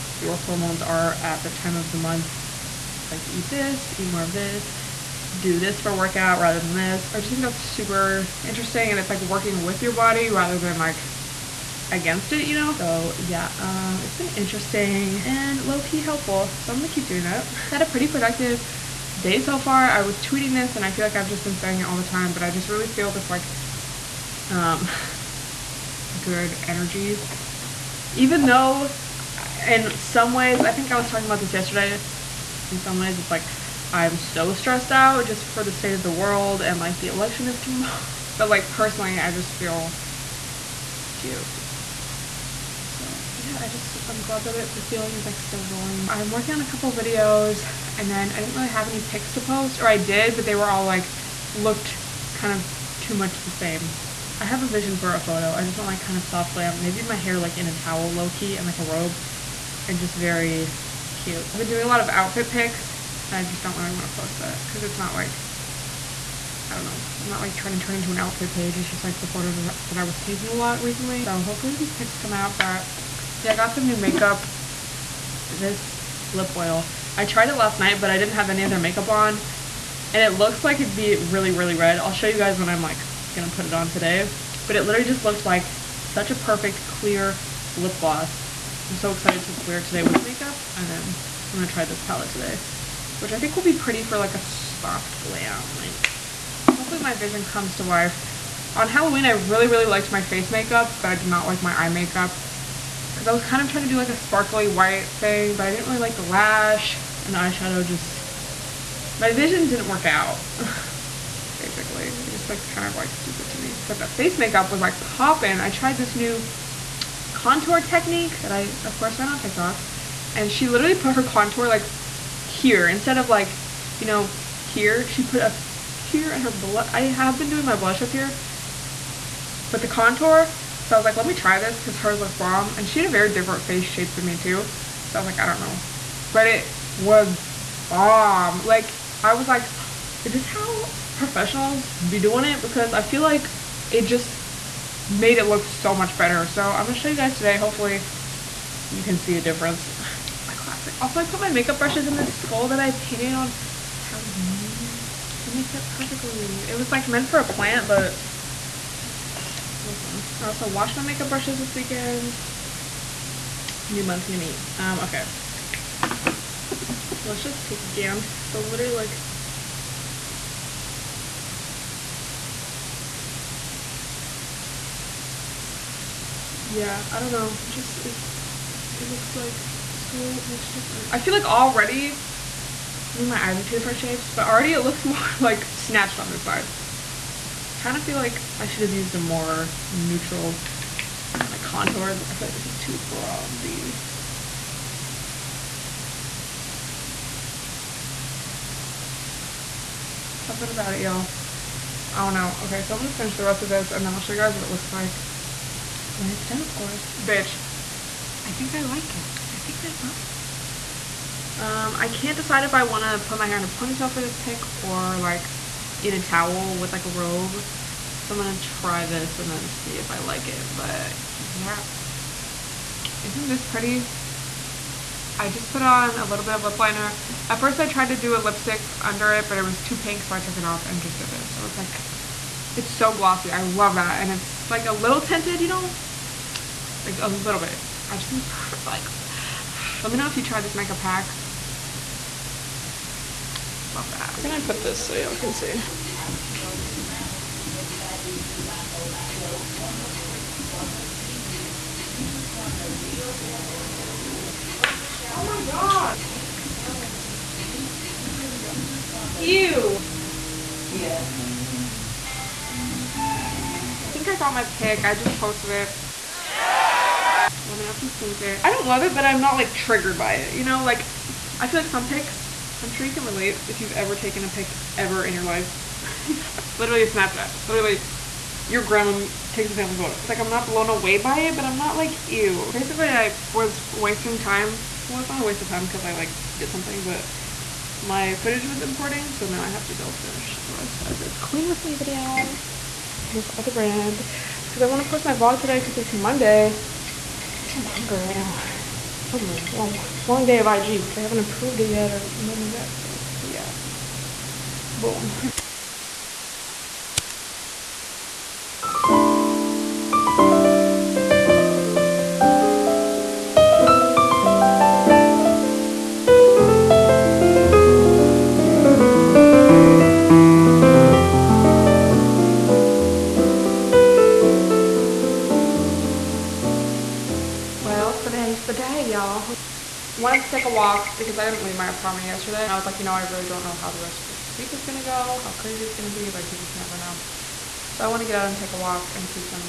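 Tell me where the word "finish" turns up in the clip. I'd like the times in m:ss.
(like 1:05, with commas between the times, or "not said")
3:23, 4:50.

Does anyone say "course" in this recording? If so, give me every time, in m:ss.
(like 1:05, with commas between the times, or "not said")
1:58, 3:26.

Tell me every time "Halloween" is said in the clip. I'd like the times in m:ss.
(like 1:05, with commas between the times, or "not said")
1:38, 2:34.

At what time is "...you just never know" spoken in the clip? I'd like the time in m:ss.
5:36.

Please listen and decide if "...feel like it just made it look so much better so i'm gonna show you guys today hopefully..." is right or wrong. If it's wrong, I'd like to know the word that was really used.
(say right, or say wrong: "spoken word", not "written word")
right.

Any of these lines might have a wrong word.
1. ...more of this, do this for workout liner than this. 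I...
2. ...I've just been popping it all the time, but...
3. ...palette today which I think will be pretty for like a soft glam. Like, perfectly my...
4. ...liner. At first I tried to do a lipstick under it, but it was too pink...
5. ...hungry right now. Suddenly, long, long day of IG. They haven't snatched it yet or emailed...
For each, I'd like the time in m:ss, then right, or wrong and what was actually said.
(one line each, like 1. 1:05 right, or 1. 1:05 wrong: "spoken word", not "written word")
1. 0:04 wrong: "rather", not "liner"
2. 0:21 wrong: "saying", not "popping"
3. 1:32 wrong: "hopefully", not "perfectly"
4. 3:46 right
5. 4:57 wrong: "approved", not "snatched".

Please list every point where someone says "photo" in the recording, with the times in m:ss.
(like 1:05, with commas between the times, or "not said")
0:55, 1:09, 4:39.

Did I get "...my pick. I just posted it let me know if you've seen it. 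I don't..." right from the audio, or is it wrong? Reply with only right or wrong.
right.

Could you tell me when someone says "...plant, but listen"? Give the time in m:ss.
2:37.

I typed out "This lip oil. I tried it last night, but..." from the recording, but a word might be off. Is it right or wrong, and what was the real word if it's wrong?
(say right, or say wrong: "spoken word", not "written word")
right.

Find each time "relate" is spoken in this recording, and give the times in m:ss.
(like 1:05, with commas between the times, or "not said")
4:33.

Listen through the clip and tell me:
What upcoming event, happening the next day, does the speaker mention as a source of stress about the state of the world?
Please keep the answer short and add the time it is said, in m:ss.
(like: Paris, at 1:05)
the election, at 0:36.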